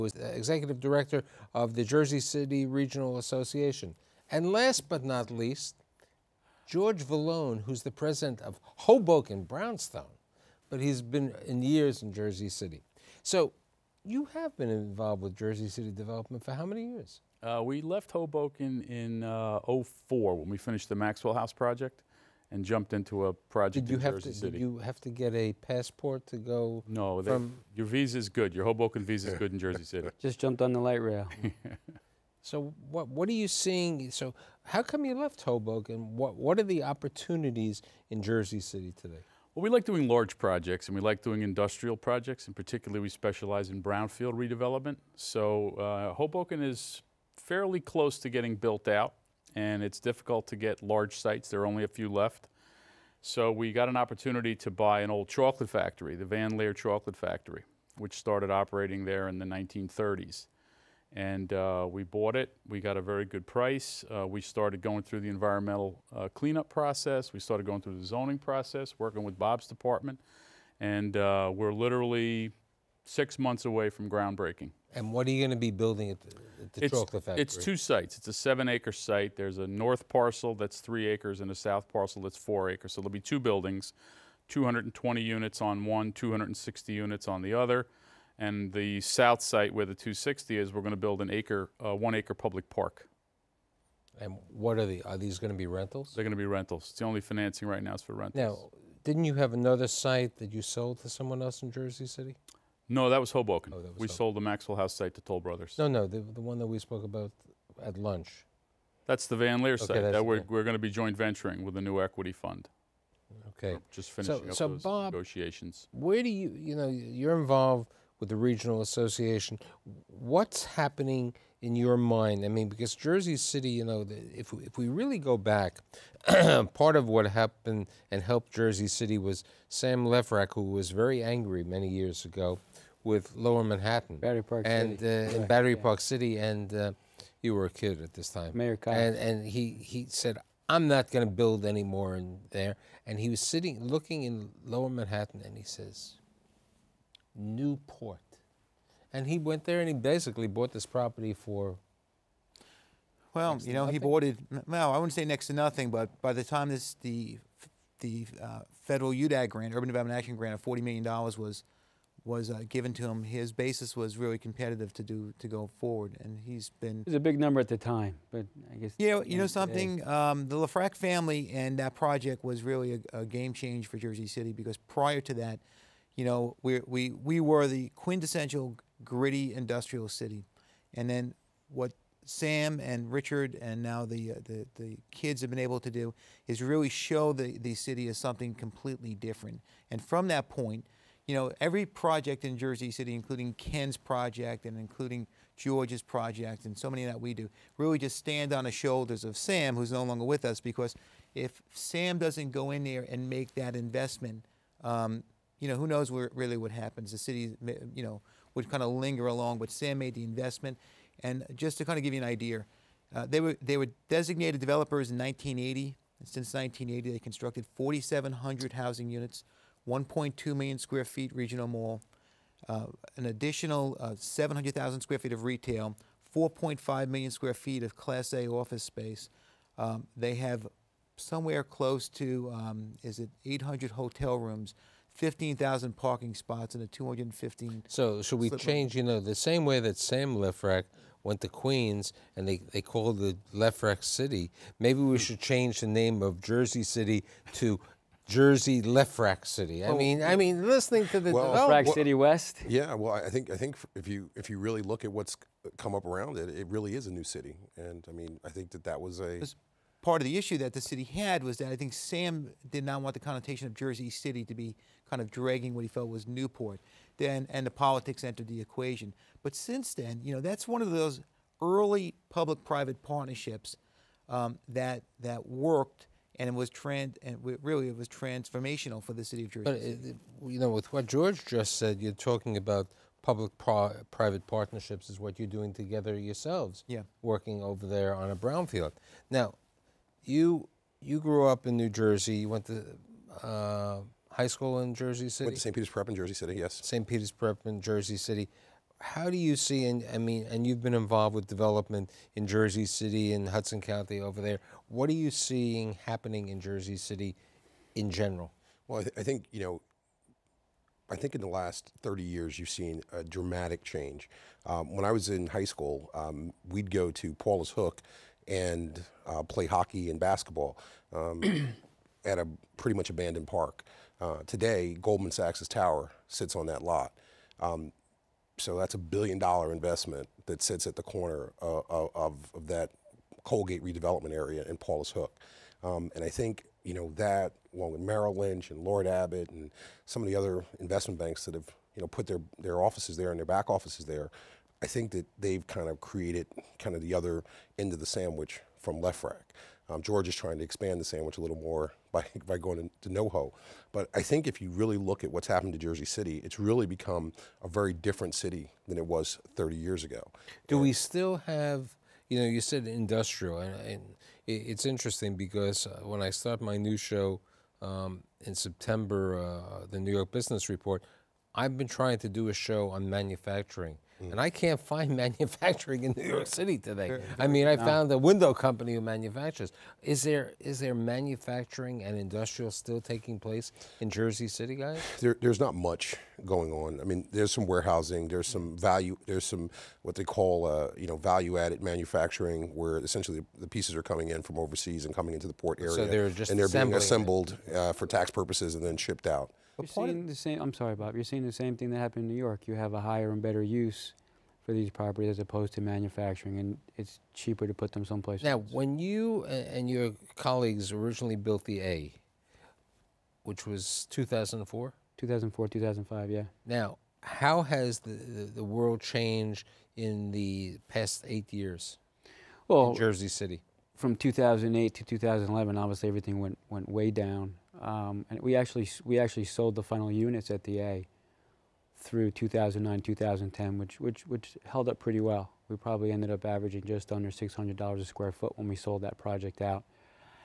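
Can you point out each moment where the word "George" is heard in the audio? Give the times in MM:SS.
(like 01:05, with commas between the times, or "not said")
00:06, 03:15, 04:41, 05:50.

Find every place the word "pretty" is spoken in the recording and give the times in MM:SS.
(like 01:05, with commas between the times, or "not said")
05:22, 07:15.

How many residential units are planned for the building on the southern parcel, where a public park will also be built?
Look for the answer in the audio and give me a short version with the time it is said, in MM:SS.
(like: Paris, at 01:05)
260, at 01:26.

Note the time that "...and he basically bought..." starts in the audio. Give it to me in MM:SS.
02:29.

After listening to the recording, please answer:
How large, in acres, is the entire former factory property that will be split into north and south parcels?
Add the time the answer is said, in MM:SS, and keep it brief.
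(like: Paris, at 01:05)
7 acres, at 01:18.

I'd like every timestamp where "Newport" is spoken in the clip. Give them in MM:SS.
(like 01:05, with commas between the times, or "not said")
02:27, 04:26.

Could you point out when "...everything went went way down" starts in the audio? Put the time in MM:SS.
07:06.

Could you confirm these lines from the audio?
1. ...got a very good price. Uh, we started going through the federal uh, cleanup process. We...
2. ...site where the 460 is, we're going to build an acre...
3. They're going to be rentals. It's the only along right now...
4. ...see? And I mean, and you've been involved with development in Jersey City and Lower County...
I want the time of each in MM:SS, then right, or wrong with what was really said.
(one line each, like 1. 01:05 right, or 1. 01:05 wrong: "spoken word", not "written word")
1. 01:02 wrong: "environmental", not "federal"
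2. 01:29 wrong: "260", not "460"
3. 01:36 wrong: "financing", not "along"
4. 04:59 wrong: "Hudson", not "Lower".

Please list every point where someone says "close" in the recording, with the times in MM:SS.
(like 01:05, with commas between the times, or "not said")
00:47, 03:51.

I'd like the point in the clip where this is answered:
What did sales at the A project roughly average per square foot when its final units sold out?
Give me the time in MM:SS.
07:16.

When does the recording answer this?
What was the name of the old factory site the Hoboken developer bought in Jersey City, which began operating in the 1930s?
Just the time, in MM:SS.
00:56.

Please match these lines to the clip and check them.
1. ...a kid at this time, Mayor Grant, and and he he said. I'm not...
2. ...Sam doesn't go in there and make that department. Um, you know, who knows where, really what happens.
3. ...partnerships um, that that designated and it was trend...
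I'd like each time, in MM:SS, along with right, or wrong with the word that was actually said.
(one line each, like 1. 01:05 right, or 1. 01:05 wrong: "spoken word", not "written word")
1. 02:17 wrong: "Cox", not "Grant"
2. 03:21 wrong: "investment", not "department"
3. 04:33 wrong: "worked", not "designated".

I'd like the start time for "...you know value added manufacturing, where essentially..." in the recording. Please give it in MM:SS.
06:30.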